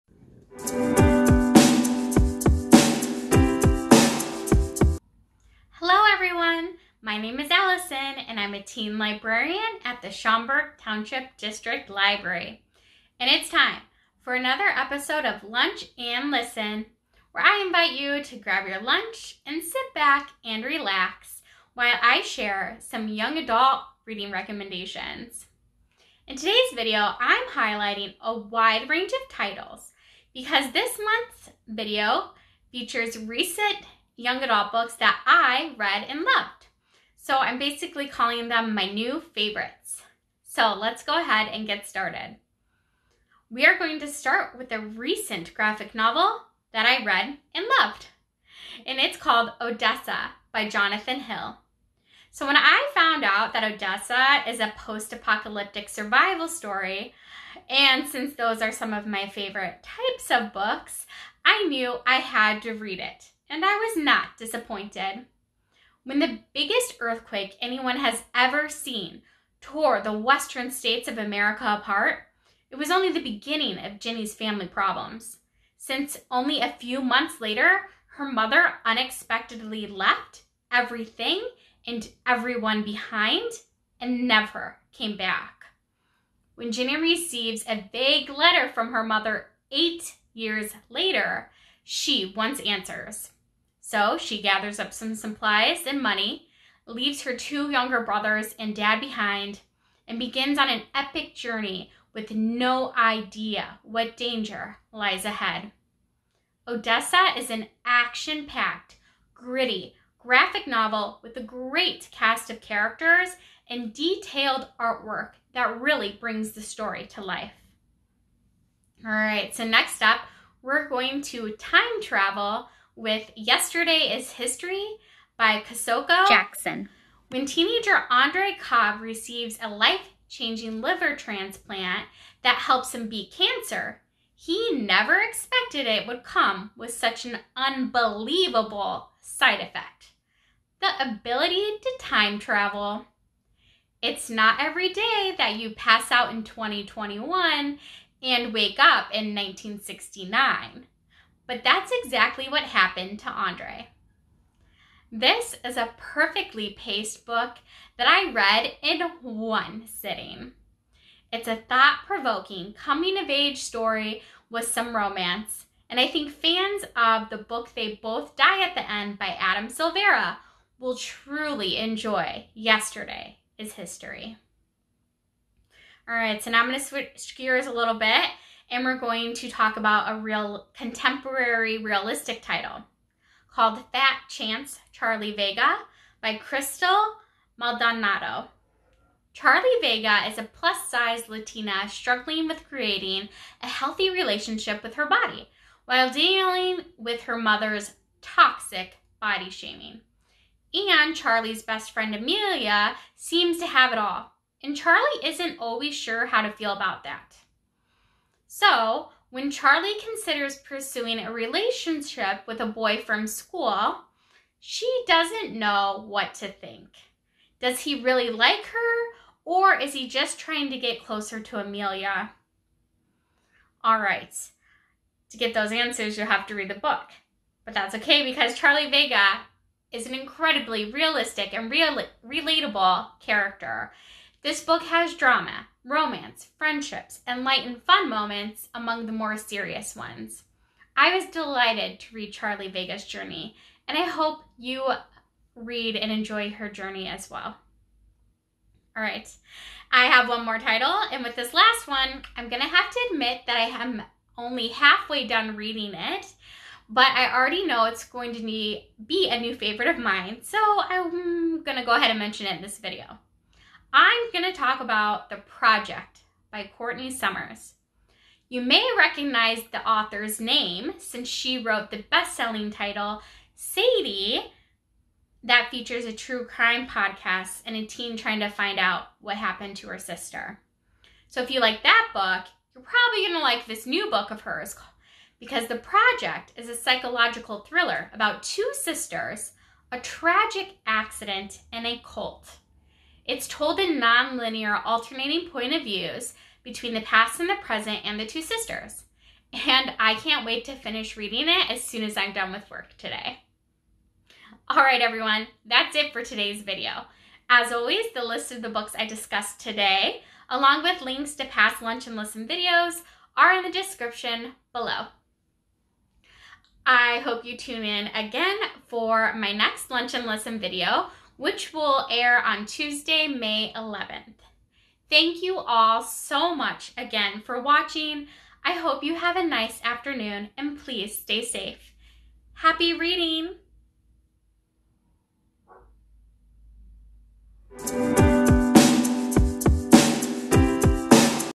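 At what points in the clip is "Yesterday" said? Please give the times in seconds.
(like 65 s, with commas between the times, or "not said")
123 s, 172 s.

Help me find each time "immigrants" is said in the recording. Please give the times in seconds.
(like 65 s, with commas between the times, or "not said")
not said.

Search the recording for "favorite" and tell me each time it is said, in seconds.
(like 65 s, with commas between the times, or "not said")
39 s, 59 s, 259 s.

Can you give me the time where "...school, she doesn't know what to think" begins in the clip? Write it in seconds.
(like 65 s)
213 s.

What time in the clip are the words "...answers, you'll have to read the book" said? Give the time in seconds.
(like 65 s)
225 s.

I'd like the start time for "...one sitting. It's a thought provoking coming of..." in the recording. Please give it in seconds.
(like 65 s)
159 s.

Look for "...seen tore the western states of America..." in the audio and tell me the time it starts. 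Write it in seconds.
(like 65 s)
68 s.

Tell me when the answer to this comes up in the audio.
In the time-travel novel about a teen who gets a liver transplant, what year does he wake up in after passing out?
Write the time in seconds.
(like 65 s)
149 s.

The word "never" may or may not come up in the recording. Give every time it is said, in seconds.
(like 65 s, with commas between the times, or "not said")
84 s, 134 s.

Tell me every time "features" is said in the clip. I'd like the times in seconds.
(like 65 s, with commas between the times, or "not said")
32 s, 275 s.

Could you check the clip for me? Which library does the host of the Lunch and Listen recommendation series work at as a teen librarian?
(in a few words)
Schaumburg Township District Library.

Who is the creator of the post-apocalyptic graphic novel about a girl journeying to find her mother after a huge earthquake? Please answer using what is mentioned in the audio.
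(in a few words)
Jonathan Hill.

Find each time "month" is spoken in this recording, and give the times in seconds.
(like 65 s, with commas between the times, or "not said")
31 s, 77 s.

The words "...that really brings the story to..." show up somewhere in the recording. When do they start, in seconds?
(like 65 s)
115 s.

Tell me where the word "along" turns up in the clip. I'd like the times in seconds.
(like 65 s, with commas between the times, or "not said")
310 s.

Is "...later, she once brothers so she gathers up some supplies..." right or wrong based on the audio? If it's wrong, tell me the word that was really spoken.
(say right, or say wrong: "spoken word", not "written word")
wrong: "answers", not "brothers".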